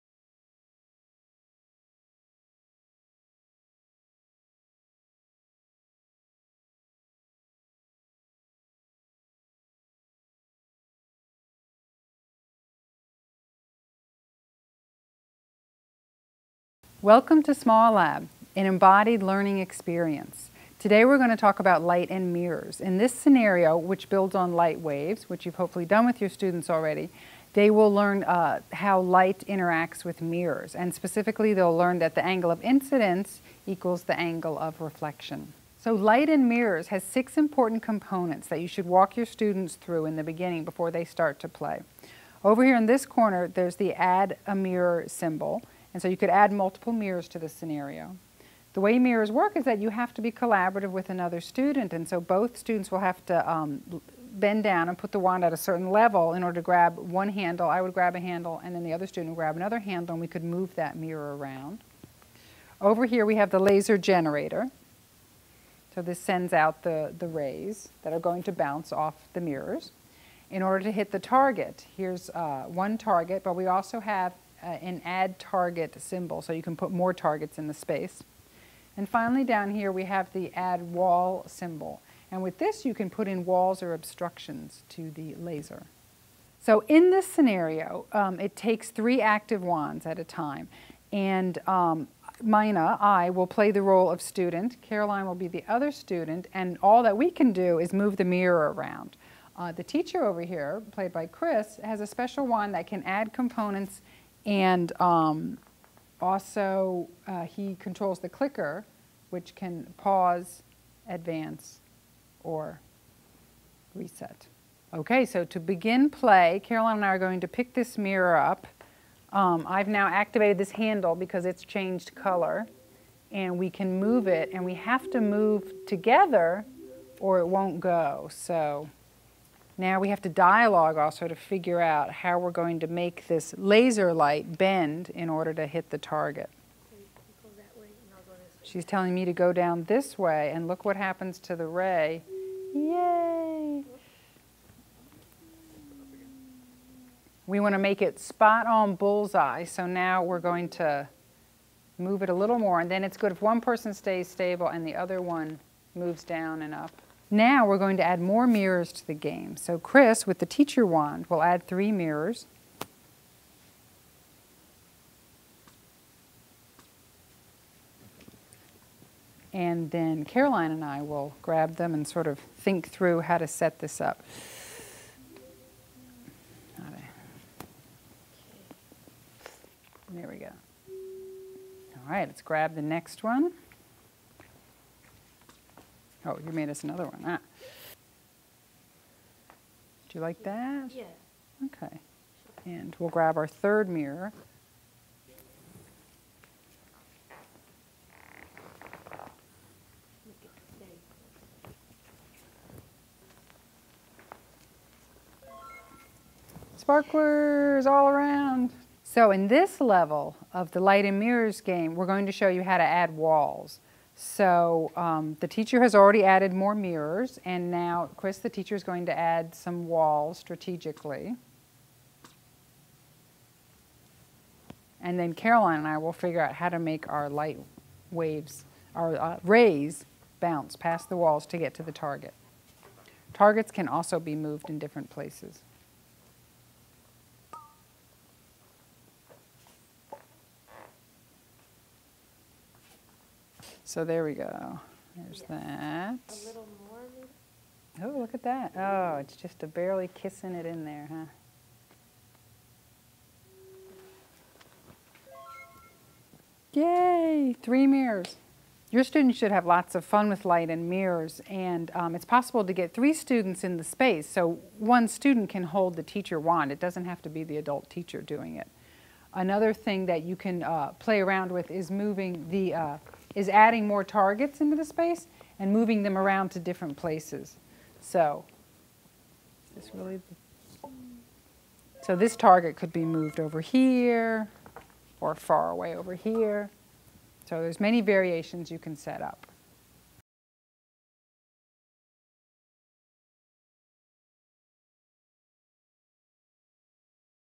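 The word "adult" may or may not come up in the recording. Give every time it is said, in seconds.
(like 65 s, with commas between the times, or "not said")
267 s.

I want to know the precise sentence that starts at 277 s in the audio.
So this really so this target could be moved over here or far away over here.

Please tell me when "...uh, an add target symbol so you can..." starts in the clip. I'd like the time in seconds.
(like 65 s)
74 s.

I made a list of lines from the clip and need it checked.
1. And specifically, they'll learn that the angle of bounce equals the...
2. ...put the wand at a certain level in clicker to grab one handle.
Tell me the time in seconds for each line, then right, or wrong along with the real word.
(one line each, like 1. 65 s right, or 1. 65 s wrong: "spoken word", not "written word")
1. 30 s wrong: "incidence", not "bounce"
2. 54 s wrong: "order", not "clicker".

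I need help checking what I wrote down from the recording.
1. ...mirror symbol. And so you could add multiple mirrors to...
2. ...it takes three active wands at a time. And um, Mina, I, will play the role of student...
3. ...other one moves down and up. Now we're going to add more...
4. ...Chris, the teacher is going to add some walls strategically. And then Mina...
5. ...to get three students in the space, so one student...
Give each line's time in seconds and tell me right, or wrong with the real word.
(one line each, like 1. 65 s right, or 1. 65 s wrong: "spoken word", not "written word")
1. 44 s right
2. 88 s right
3. 154 s right
4. 218 s wrong: "Caroline", not "Mina"
5. 262 s right.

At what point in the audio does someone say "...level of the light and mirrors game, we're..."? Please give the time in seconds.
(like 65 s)
209 s.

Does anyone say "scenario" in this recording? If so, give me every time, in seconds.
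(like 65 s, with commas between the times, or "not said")
23 s, 47 s, 87 s.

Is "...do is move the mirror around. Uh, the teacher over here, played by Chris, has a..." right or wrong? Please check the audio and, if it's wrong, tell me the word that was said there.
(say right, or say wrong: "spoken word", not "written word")
right.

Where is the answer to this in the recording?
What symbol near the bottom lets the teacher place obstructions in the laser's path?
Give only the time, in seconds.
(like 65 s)
80 s.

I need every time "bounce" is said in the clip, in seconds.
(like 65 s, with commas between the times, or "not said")
68 s, 230 s.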